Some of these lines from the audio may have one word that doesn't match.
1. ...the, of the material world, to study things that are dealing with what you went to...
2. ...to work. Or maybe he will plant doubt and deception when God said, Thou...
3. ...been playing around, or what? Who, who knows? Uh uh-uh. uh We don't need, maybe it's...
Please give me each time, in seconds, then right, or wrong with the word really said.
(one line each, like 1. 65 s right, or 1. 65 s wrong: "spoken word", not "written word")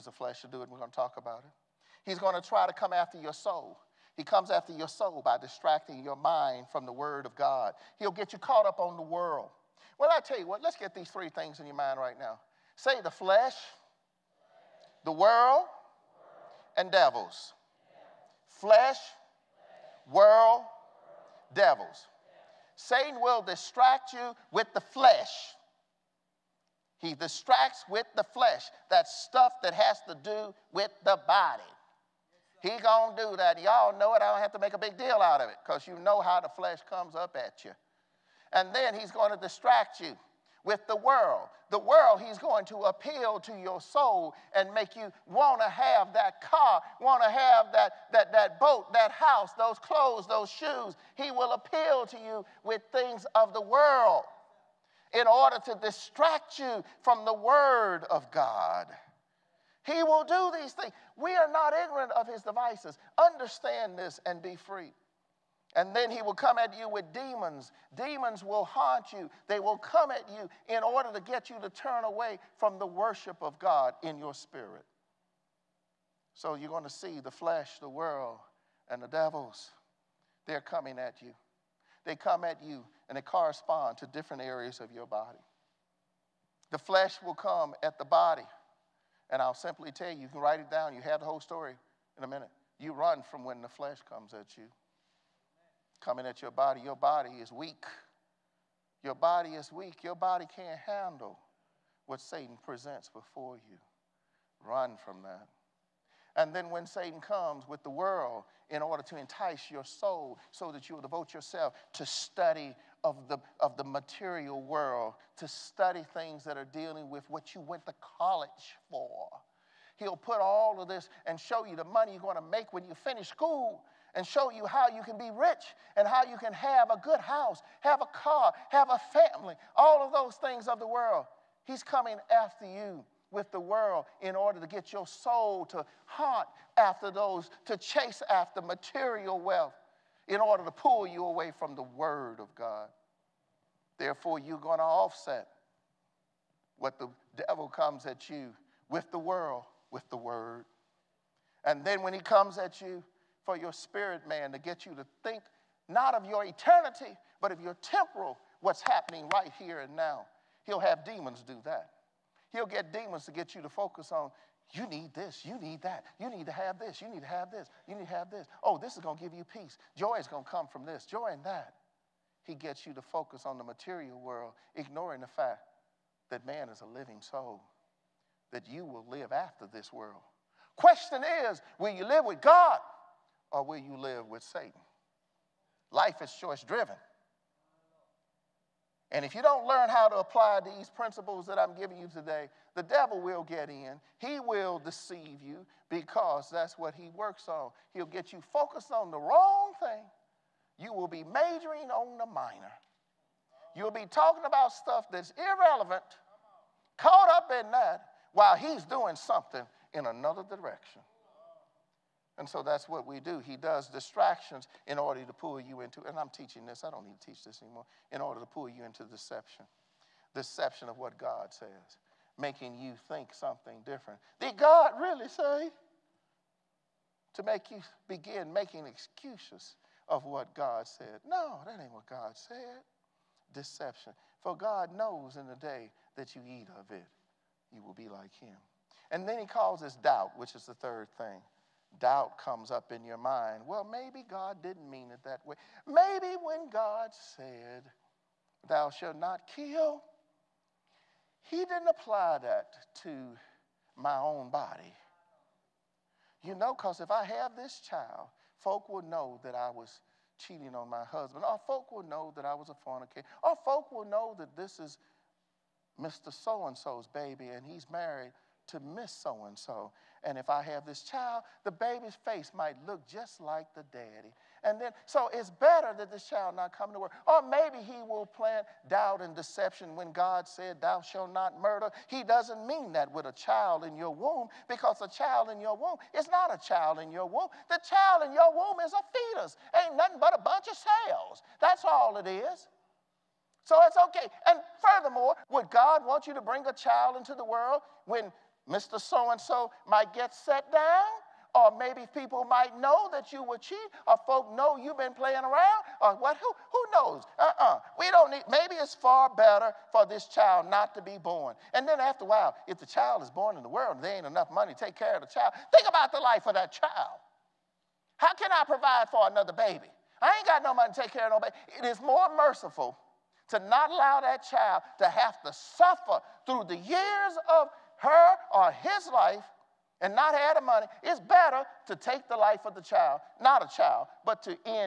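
1. 113 s right
2. 276 s right
3. 304 s right.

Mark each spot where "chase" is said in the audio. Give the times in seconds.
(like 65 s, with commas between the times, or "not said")
137 s.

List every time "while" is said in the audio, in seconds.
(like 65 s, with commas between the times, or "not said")
208 s, 312 s.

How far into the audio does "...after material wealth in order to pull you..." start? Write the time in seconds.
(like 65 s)
138 s.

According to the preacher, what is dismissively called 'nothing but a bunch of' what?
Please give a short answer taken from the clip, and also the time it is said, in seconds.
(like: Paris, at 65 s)
cells, at 290 s.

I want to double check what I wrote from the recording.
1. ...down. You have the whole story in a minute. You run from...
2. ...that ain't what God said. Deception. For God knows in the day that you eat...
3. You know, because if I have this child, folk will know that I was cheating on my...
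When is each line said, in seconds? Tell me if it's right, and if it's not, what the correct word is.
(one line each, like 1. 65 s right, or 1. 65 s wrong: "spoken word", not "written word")
1. 90 s right
2. 231 s right
3. 256 s right.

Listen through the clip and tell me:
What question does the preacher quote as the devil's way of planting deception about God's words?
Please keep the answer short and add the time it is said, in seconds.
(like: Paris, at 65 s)
Did God really say?, at 224 s.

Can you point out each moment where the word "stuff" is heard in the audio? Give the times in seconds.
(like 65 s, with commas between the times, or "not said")
29 s, 204 s.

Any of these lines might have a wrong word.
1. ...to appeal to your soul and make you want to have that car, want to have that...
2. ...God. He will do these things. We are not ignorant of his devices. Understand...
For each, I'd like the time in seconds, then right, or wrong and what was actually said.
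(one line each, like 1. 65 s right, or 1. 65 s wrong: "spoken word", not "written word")
1. 42 s right
2. 58 s right.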